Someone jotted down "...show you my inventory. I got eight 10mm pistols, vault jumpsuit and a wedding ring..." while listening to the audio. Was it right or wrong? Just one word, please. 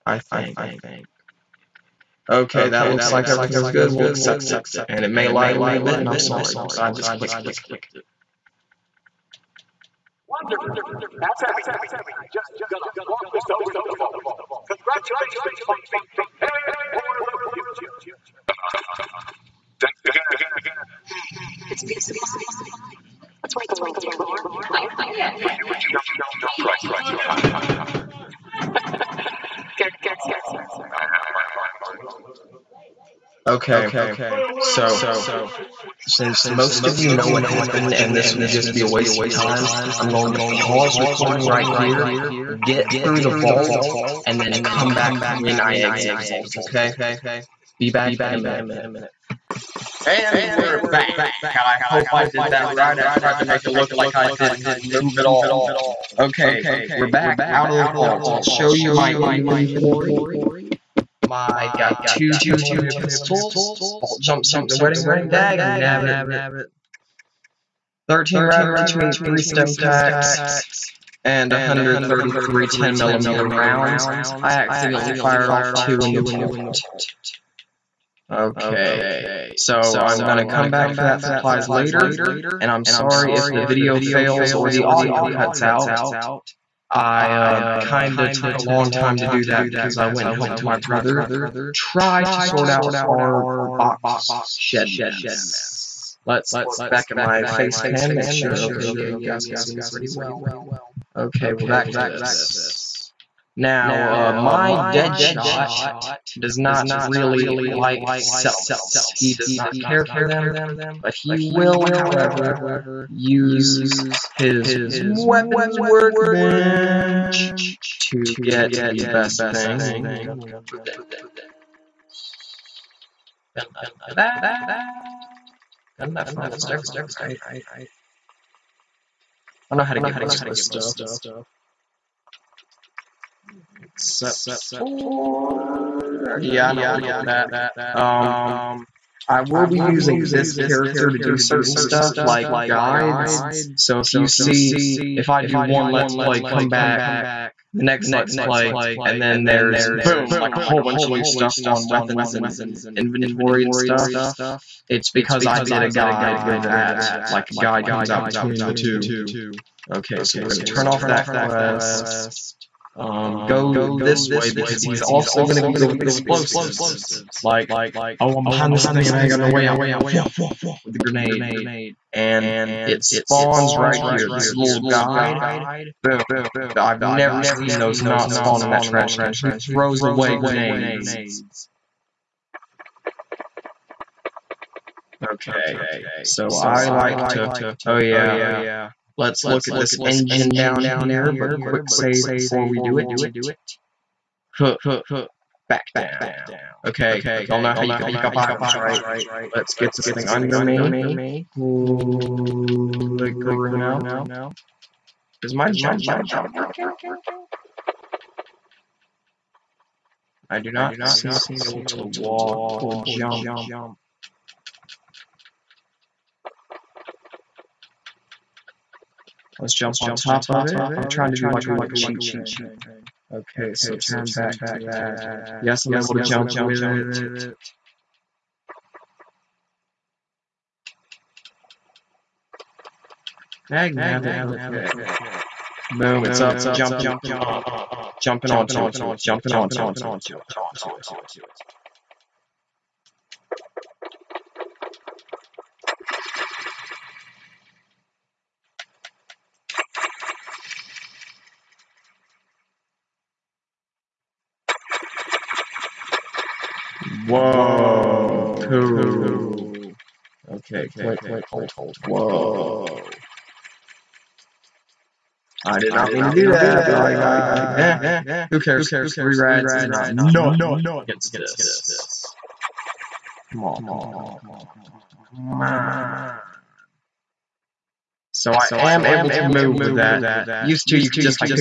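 wrong.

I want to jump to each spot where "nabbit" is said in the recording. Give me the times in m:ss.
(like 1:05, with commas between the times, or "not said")
1:05, 3:54.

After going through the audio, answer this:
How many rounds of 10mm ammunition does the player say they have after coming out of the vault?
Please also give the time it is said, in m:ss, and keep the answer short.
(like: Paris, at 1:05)
133, at 1:11.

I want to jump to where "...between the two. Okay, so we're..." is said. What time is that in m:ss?
2:38.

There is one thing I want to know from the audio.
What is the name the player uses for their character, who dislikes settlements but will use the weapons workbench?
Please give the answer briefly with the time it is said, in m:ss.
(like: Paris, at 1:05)
Deadshot, at 1:44.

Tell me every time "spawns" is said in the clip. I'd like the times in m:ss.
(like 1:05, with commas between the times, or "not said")
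2:53, 2:58.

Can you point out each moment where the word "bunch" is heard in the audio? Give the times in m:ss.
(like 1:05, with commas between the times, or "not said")
2:30.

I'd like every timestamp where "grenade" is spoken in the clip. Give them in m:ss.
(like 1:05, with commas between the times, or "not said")
2:50, 3:00.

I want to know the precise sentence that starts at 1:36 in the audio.
Let's look back at my face cam, make sure, okay, yeah, you guys can see me pretty well.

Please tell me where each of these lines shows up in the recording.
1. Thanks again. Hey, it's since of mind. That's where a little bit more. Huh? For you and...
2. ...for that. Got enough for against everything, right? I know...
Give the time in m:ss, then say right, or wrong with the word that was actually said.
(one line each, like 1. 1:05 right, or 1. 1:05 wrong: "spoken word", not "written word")
1. 0:19 wrong: "peace", not "since"
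2. 2:04 wrong: "almost", not "against".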